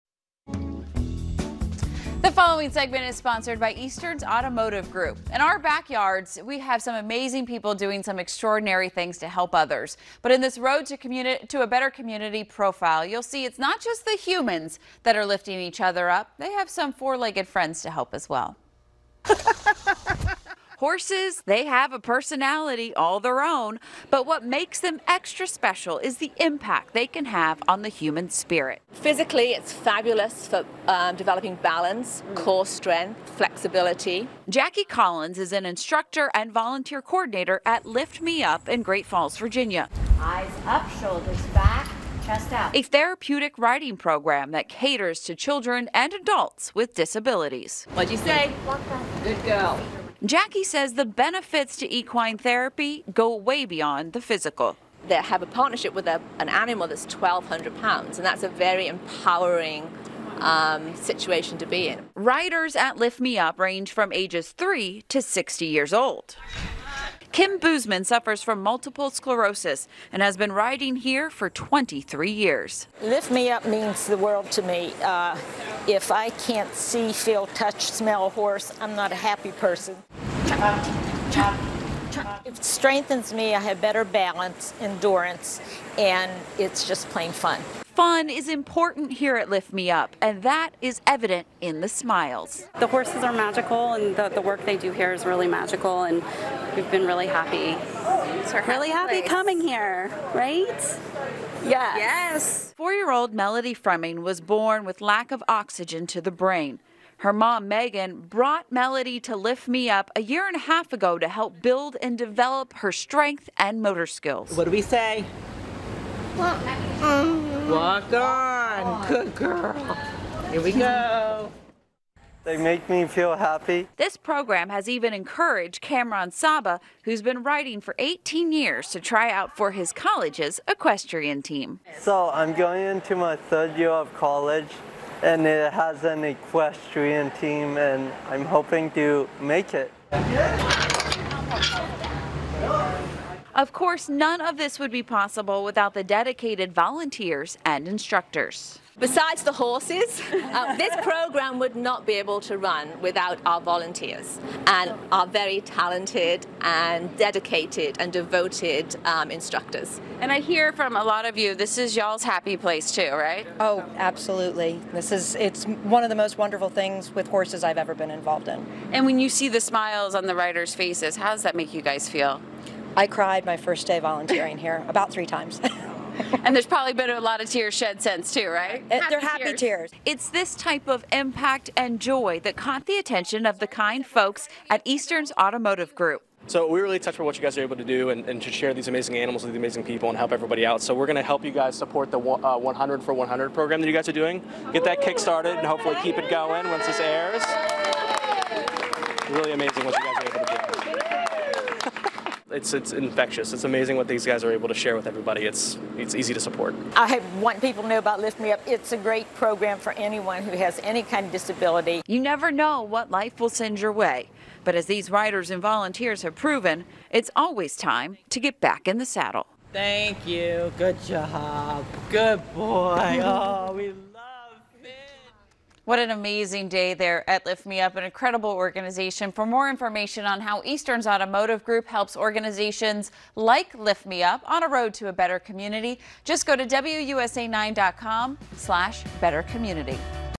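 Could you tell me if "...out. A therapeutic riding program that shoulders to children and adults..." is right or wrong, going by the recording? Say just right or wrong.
wrong.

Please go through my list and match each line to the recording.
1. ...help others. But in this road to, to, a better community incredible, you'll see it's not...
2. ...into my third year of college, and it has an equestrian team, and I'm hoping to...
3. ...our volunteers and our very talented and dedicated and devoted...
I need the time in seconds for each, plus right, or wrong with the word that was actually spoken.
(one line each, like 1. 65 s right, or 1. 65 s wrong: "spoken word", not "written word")
1. 9 s wrong: "profile", not "incredible"
2. 132 s right
3. 153 s right.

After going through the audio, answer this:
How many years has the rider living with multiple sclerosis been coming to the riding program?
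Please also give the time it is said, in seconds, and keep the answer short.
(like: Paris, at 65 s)
23 years, at 71 s.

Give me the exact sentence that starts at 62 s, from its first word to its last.
Riders at Lift Me Up range from ages 3 to 60 years old.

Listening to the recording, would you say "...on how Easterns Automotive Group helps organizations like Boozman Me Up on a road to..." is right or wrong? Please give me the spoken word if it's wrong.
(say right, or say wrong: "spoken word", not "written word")
wrong: "Lift", not "Boozman".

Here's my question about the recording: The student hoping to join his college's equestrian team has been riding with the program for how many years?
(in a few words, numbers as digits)
18 years.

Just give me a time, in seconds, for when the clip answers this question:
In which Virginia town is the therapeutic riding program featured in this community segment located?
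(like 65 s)
38 s.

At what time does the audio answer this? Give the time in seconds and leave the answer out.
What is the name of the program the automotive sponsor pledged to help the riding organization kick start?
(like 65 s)
192 s.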